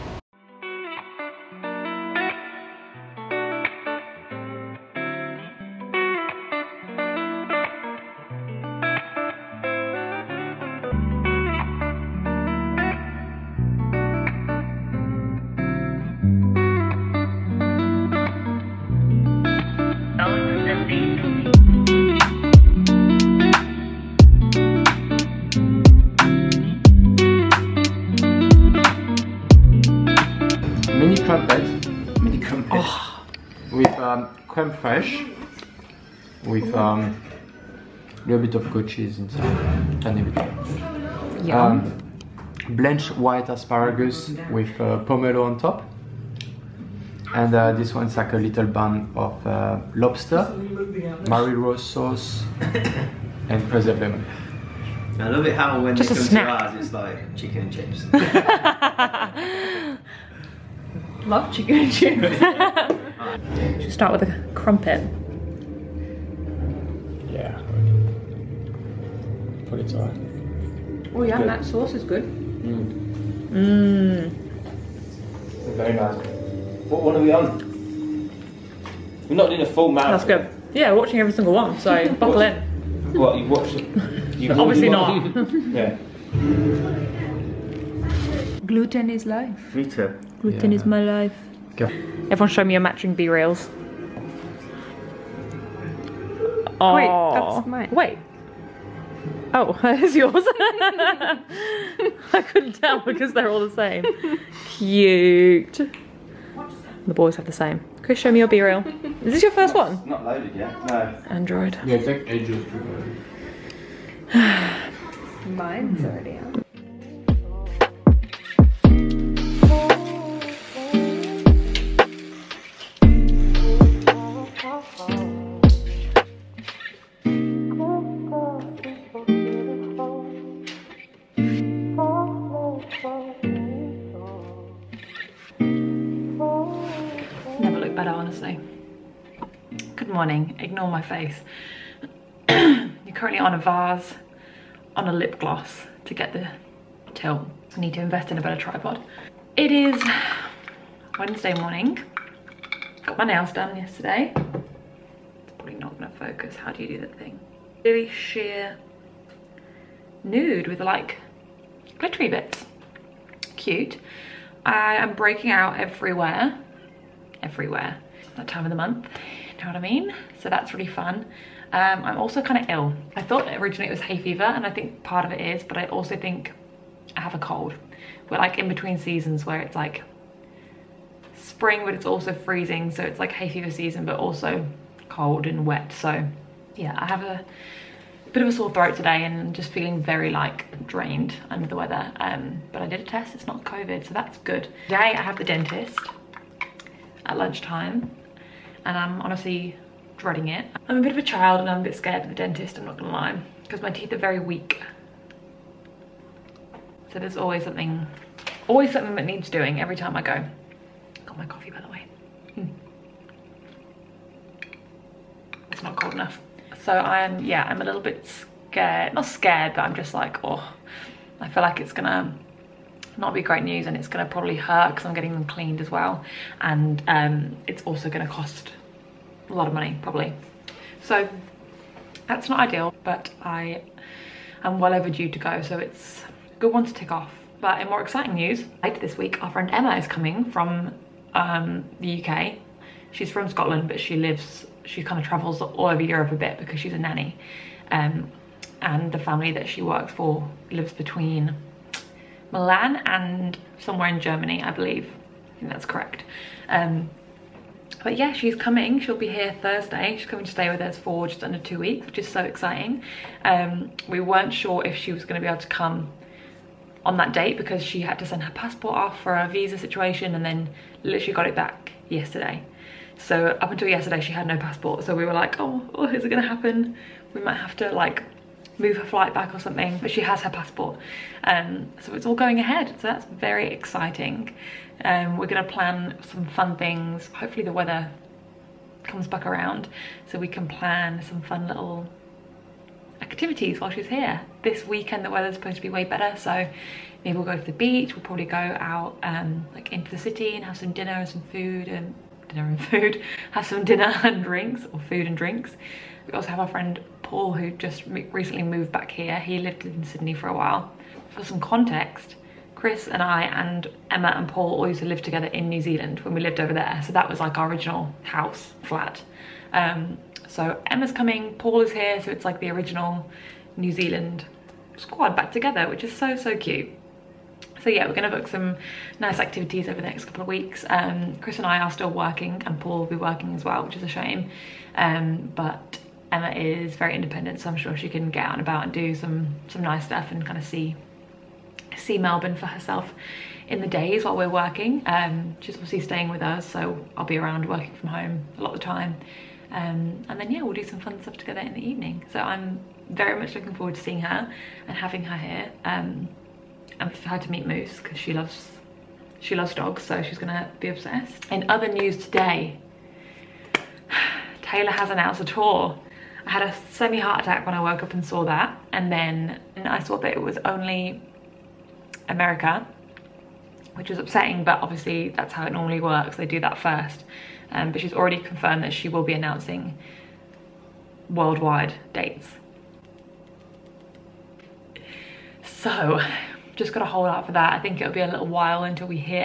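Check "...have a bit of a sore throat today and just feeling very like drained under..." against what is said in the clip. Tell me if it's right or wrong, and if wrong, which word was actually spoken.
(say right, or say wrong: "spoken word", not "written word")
right.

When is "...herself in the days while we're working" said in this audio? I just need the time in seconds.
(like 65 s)
342 s.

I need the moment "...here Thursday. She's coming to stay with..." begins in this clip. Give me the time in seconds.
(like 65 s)
259 s.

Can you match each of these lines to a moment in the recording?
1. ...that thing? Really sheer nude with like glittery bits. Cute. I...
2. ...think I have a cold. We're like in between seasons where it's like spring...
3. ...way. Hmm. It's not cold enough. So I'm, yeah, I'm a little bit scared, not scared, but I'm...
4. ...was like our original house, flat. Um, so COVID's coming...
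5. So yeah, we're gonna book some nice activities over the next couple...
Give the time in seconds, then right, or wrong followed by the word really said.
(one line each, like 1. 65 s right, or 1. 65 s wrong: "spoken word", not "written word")
1. 156 s right
2. 176 s right
3. 211 s right
4. 317 s wrong: "Emma", not "COVID"
5. 327 s right.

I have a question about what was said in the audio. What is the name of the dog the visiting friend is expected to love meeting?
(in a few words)
Moose.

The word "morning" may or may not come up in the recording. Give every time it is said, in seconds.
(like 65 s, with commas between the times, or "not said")
140 s, 151 s.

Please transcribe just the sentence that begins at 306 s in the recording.
We also have our friend Paul who just recently moved back here.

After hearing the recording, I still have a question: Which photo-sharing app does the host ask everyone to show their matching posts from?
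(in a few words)
BeReal.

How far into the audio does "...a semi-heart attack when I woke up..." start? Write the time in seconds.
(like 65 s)
366 s.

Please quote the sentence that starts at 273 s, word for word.
So up until yesterday, she had no passport.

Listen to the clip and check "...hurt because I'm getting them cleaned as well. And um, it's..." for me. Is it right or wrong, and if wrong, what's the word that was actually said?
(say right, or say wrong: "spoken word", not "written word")
right.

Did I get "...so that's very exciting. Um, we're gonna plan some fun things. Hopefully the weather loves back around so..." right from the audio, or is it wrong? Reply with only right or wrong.
wrong.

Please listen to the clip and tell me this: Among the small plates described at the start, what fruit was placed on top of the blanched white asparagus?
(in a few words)
pomelo.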